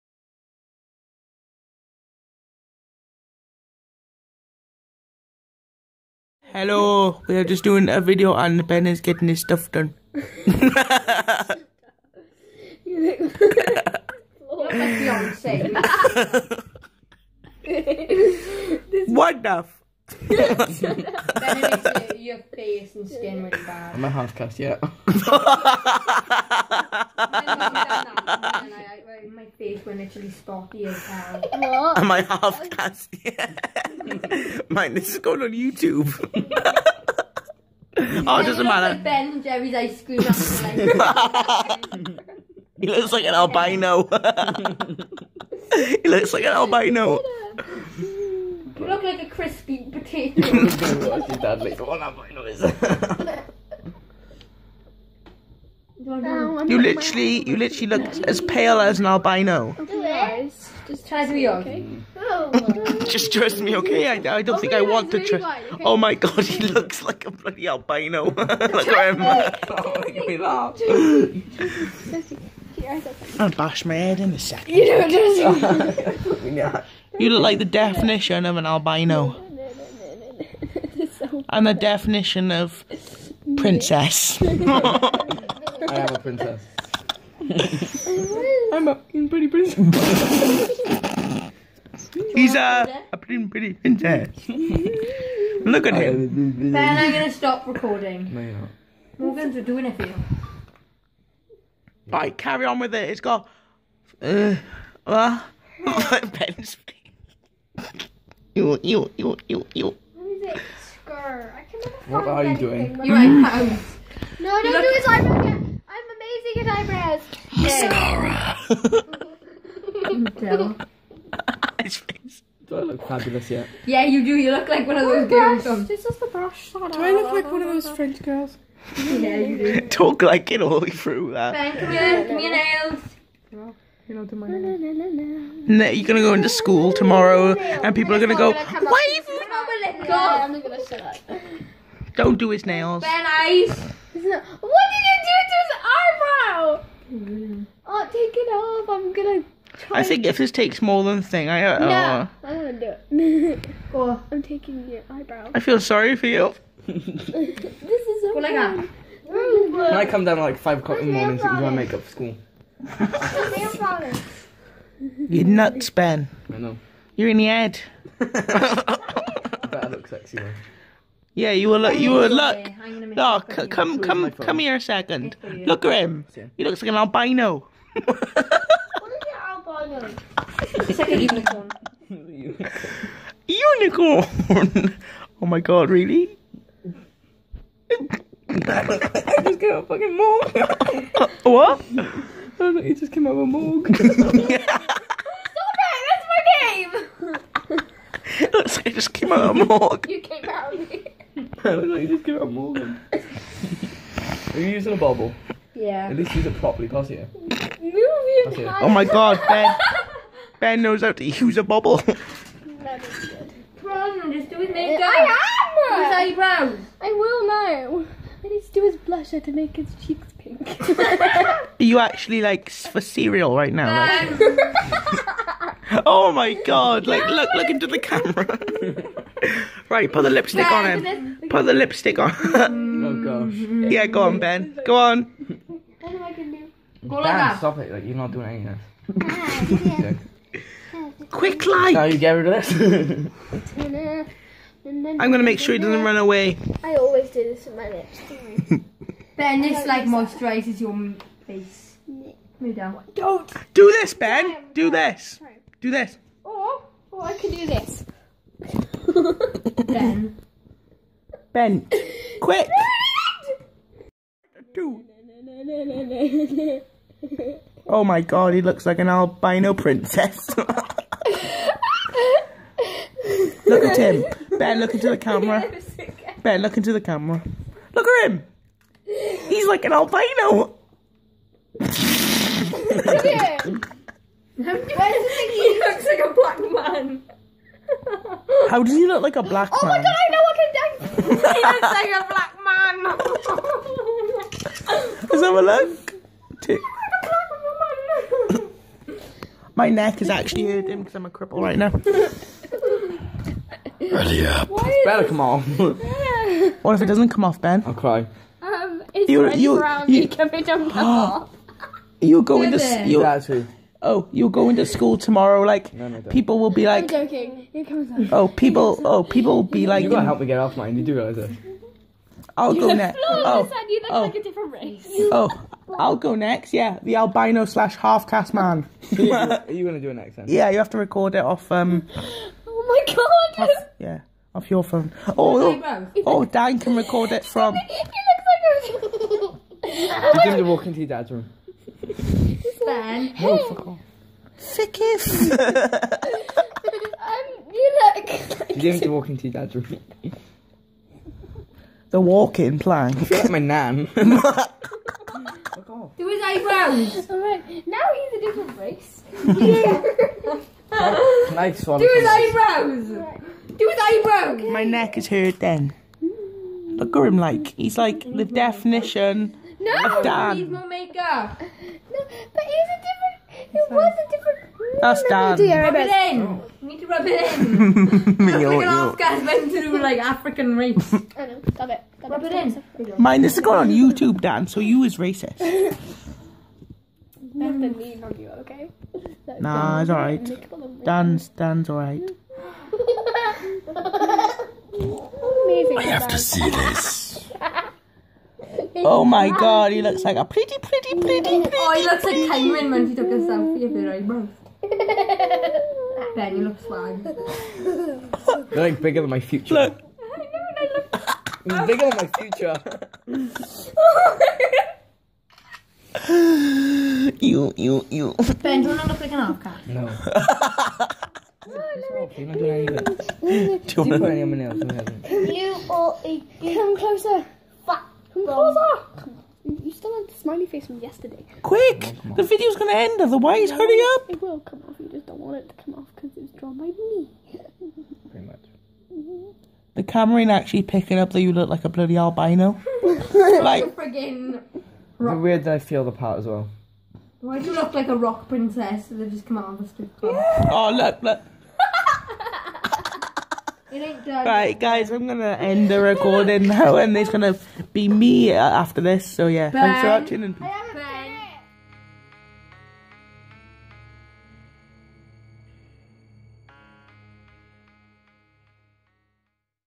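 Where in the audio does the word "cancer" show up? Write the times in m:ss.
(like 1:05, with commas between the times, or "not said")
not said.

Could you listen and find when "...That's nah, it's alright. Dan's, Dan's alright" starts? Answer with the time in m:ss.
6:29.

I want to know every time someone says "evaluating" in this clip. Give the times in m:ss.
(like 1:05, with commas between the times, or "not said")
not said.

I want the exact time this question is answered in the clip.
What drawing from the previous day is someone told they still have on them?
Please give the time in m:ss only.
7:10.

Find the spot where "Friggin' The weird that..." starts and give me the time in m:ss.
7:23.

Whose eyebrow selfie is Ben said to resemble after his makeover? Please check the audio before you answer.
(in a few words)
Cameron.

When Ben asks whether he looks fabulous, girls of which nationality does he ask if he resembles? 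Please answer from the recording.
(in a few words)
French.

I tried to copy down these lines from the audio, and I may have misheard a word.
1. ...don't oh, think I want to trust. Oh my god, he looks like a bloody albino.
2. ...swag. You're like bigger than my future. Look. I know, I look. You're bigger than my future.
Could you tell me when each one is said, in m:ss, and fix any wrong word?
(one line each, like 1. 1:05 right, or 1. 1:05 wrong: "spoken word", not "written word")
1. 1:04 right
2. 6:46 right.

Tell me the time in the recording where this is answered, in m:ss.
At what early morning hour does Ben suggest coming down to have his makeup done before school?
2:40.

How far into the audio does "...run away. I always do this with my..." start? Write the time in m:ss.
4:06.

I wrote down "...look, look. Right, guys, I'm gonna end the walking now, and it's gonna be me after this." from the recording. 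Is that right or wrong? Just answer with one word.
wrong.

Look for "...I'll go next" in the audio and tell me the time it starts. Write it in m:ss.
5:25.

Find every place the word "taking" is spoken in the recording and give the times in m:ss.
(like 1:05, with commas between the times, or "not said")
2:34.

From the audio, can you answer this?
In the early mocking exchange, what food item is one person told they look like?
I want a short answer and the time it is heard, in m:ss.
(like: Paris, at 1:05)
crispy potato, at 0:49.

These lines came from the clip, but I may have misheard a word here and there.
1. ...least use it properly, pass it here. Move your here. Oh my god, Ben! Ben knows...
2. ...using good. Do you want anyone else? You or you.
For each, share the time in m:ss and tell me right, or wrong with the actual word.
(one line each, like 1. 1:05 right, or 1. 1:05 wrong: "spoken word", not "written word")
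1. 3:26 right
2. 7:02 wrong: "anything", not "using".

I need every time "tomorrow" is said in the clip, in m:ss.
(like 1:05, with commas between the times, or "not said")
2:16, 5:15.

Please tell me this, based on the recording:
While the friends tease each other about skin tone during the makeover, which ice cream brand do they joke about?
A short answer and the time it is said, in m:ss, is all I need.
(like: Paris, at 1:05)
Ben and Jerry's, at 0:39.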